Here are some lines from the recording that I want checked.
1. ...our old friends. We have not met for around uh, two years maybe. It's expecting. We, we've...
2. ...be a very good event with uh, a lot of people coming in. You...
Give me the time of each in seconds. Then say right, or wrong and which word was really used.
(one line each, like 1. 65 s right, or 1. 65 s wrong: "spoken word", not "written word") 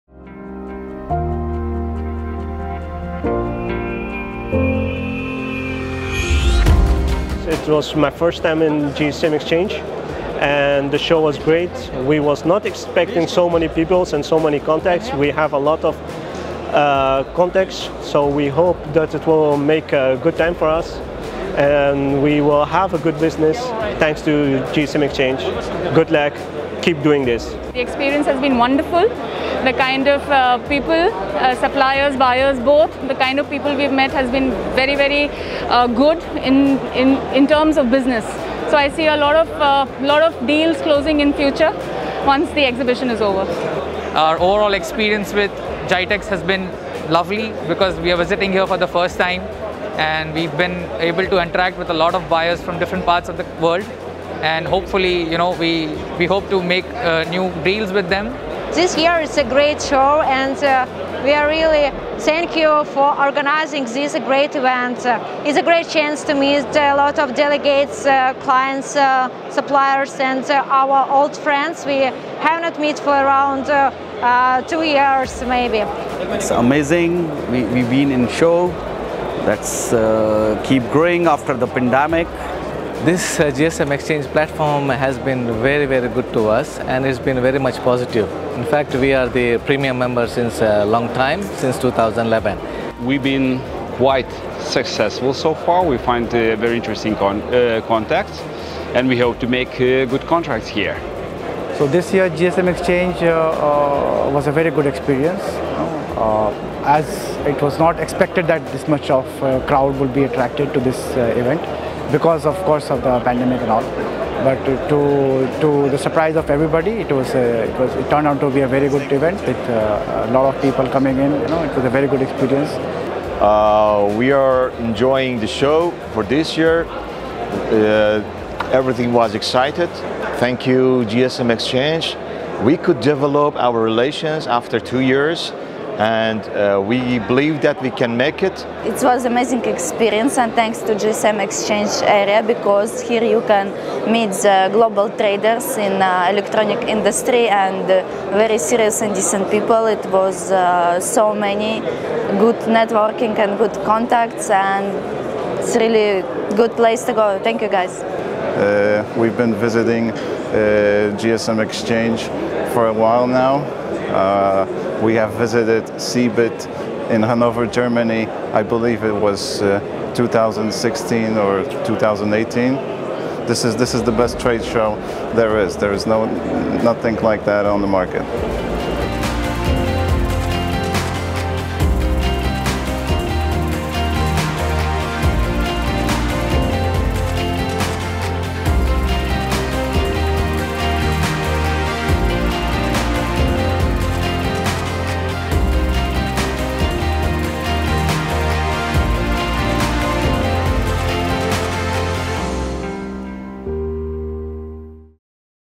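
1. 70 s wrong: "amazing", not "expecting"
2. 118 s right.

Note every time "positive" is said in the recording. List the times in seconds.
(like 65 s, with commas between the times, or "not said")
87 s.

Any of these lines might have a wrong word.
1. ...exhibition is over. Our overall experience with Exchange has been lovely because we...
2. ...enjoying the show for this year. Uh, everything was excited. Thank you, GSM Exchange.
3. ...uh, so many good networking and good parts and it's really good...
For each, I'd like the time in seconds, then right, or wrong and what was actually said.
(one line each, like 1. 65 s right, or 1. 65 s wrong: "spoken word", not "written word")
1. 42 s wrong: "GITEX", not "Exchange"
2. 124 s right
3. 150 s wrong: "contacts", not "parts".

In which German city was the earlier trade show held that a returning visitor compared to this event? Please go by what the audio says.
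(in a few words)
Hanover.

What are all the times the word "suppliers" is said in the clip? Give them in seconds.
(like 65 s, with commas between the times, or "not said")
31 s, 69 s.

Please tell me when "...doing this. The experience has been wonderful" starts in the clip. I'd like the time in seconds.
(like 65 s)
27 s.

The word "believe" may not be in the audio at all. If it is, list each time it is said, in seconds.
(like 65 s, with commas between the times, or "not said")
137 s, 168 s.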